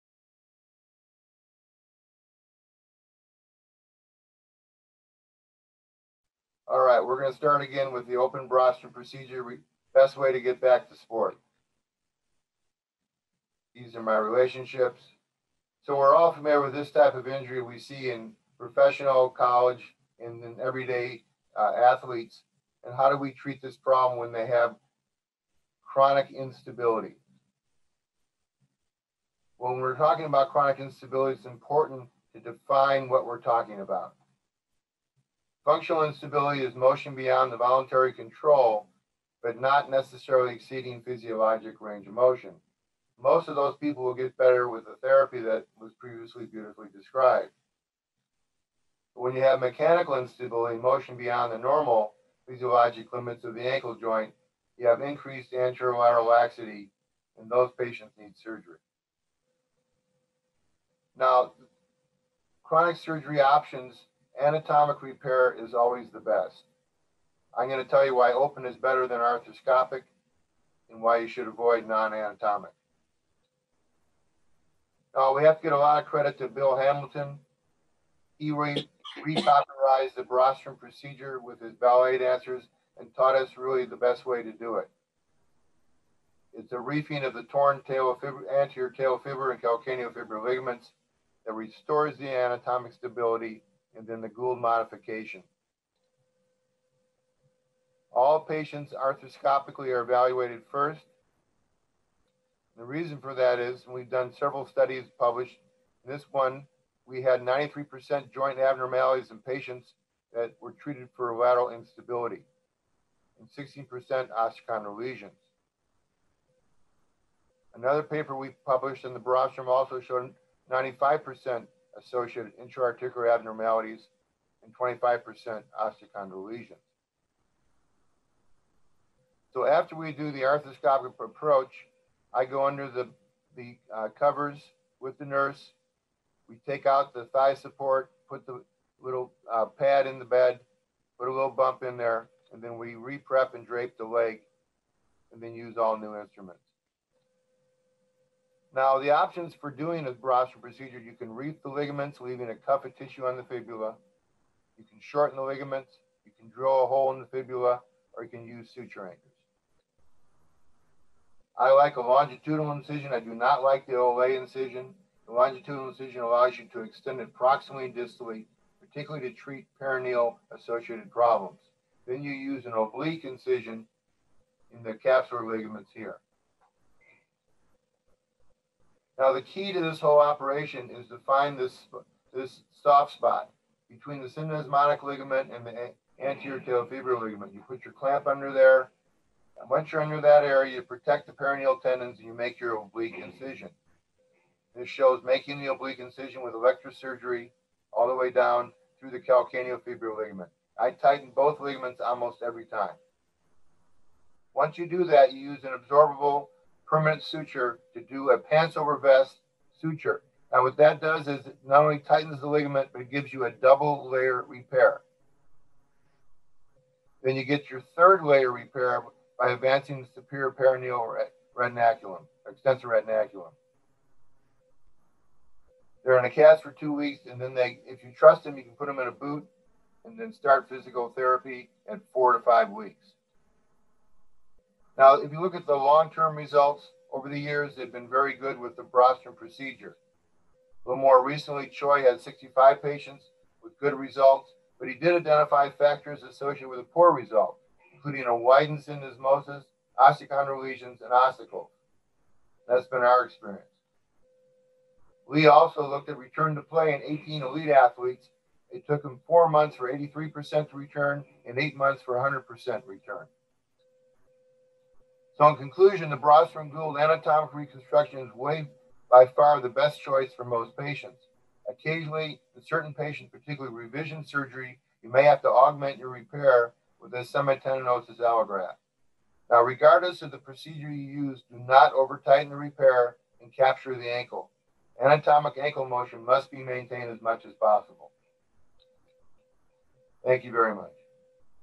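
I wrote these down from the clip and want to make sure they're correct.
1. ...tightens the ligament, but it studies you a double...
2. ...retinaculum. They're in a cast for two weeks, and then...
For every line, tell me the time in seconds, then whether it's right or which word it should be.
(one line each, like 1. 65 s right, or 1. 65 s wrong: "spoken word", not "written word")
1. 211 s wrong: "gives", not "studies"
2. 222 s right.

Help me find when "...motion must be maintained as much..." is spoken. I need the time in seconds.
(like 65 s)
285 s.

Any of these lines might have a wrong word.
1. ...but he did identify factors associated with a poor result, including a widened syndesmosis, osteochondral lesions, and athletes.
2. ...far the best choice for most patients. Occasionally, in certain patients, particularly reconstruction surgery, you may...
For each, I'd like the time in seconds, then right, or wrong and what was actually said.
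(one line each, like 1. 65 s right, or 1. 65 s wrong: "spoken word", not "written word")
1. 244 s wrong: "ossicles", not "athletes"
2. 269 s wrong: "revision", not "reconstruction".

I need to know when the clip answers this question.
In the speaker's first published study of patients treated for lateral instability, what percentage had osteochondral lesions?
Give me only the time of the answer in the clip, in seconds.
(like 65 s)
113 s.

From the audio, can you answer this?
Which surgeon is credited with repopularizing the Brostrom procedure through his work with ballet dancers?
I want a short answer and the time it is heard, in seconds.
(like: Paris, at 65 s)
Bill Hamilton, at 76 s.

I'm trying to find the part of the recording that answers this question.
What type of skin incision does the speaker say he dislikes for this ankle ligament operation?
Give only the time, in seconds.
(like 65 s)
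163 s.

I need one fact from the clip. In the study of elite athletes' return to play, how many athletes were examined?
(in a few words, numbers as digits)
18.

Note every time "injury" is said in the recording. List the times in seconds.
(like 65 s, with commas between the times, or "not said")
17 s.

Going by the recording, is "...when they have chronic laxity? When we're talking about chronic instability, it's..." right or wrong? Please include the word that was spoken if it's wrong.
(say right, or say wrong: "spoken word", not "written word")
wrong: "instability", not "laxity".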